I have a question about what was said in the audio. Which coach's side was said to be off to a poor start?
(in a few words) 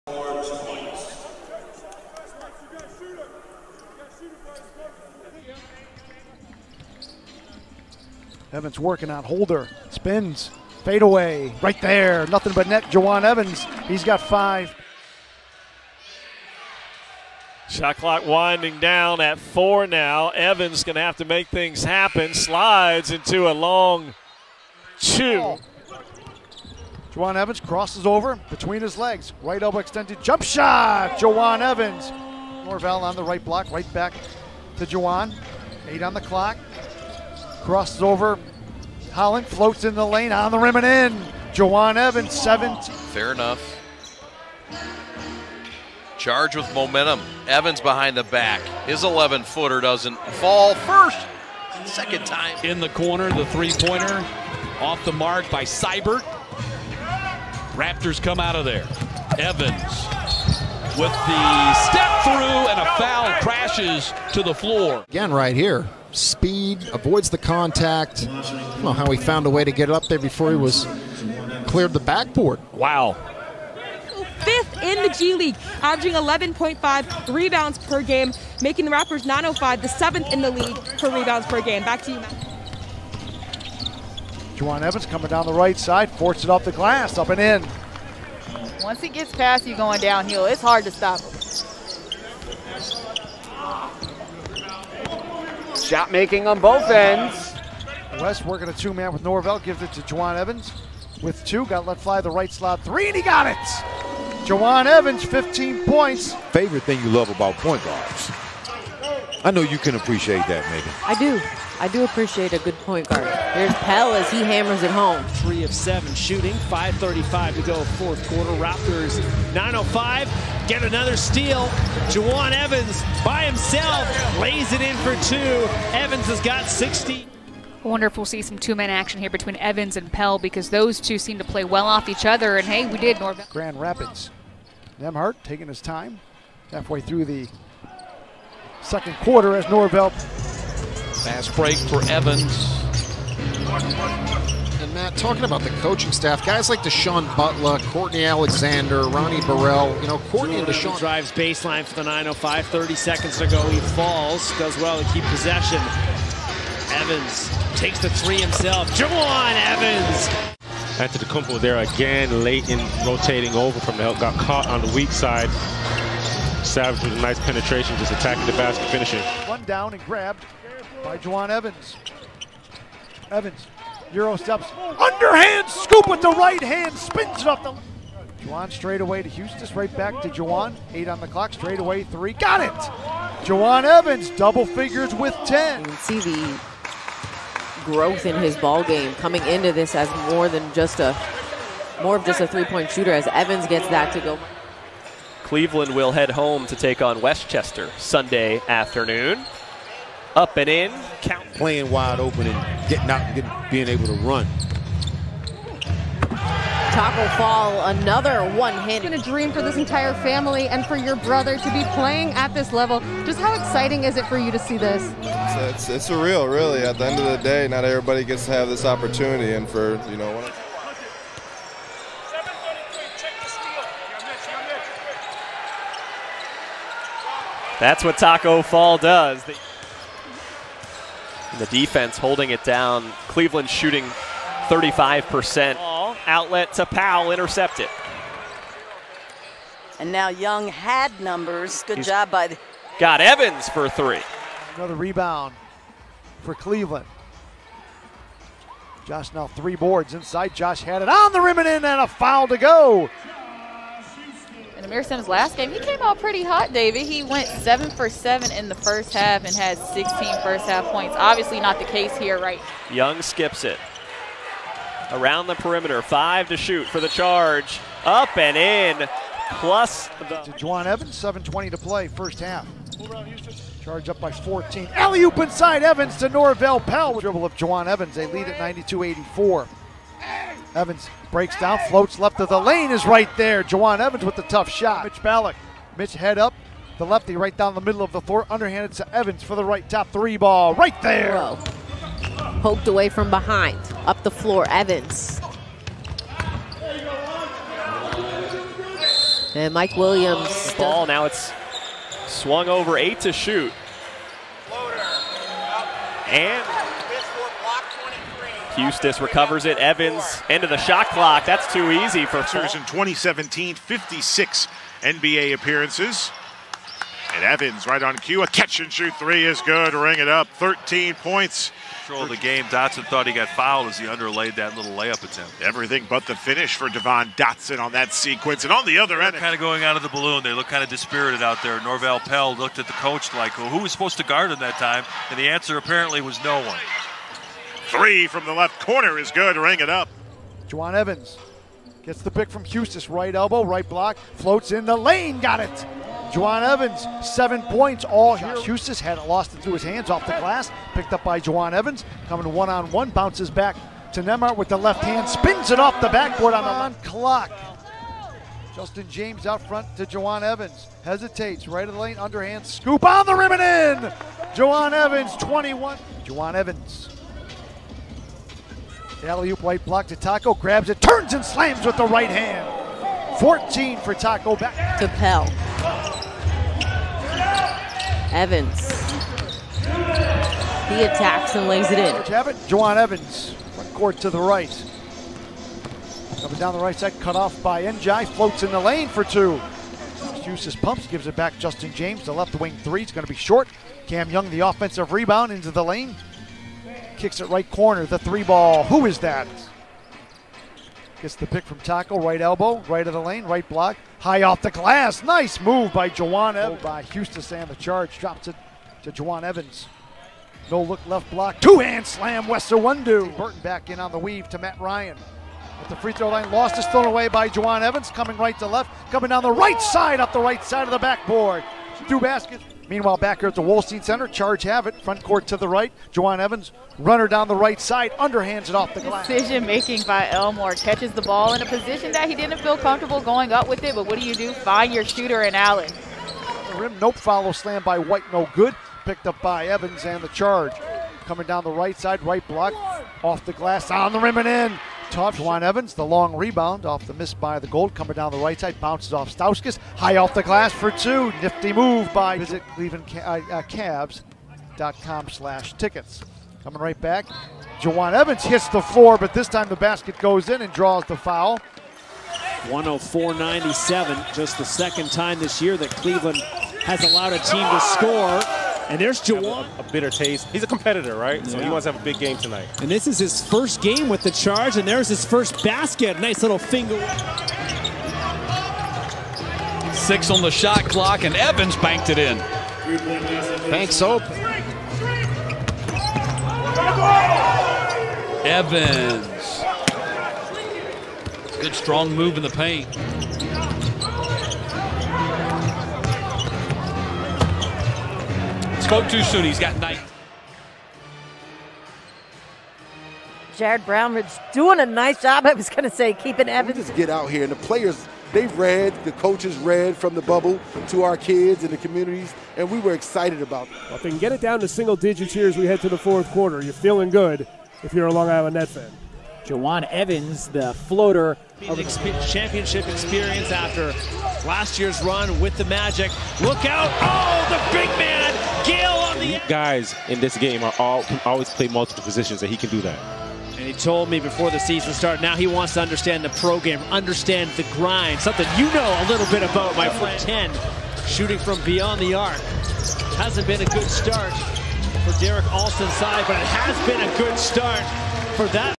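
Derek Alston.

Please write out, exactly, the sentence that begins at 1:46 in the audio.
Favorite thing you love about point guards.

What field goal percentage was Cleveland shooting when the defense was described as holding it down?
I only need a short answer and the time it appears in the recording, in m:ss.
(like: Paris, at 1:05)
35%, at 3:54.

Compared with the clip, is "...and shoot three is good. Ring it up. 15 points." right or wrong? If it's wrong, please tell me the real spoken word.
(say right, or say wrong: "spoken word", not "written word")
wrong: "13", not "15".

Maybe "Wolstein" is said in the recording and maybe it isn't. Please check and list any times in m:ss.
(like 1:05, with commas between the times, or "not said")
7:03.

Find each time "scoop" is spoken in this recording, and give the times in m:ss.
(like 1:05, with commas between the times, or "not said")
2:55, 6:02.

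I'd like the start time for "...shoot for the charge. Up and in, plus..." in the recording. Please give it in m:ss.
4:26.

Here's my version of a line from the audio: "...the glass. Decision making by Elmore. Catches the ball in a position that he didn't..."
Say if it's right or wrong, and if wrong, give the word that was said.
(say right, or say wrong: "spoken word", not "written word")
right.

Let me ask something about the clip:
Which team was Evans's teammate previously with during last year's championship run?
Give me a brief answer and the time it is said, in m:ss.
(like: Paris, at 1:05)
Magic, at 8:45.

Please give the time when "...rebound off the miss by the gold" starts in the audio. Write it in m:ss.
7:26.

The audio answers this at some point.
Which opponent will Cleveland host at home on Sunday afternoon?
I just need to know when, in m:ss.
3:17.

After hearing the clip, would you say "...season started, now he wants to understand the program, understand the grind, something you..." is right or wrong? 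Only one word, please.
right.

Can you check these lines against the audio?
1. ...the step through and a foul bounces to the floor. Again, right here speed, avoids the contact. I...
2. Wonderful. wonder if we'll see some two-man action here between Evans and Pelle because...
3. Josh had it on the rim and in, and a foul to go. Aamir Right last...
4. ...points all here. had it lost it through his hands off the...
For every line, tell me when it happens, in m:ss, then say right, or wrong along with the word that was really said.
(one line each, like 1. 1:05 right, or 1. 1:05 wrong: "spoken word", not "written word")
1. 1:01 wrong: "crashes", not "bounces"
2. 2:07 right
3. 4:10 wrong: "Simms", not "Right"
4. 5:47 right.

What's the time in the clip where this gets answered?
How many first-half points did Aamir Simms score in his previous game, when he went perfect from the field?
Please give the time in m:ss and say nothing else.
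4:19.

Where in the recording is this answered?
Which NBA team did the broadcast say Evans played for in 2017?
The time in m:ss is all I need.
5:12.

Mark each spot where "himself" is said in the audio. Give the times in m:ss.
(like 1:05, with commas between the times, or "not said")
2:03, 2:38.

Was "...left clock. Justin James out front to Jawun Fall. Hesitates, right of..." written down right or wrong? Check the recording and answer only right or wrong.
wrong.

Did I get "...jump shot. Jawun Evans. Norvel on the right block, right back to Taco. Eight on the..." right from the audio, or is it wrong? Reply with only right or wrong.
wrong.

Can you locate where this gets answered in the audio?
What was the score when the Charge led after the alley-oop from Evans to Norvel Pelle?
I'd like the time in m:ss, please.
4:38.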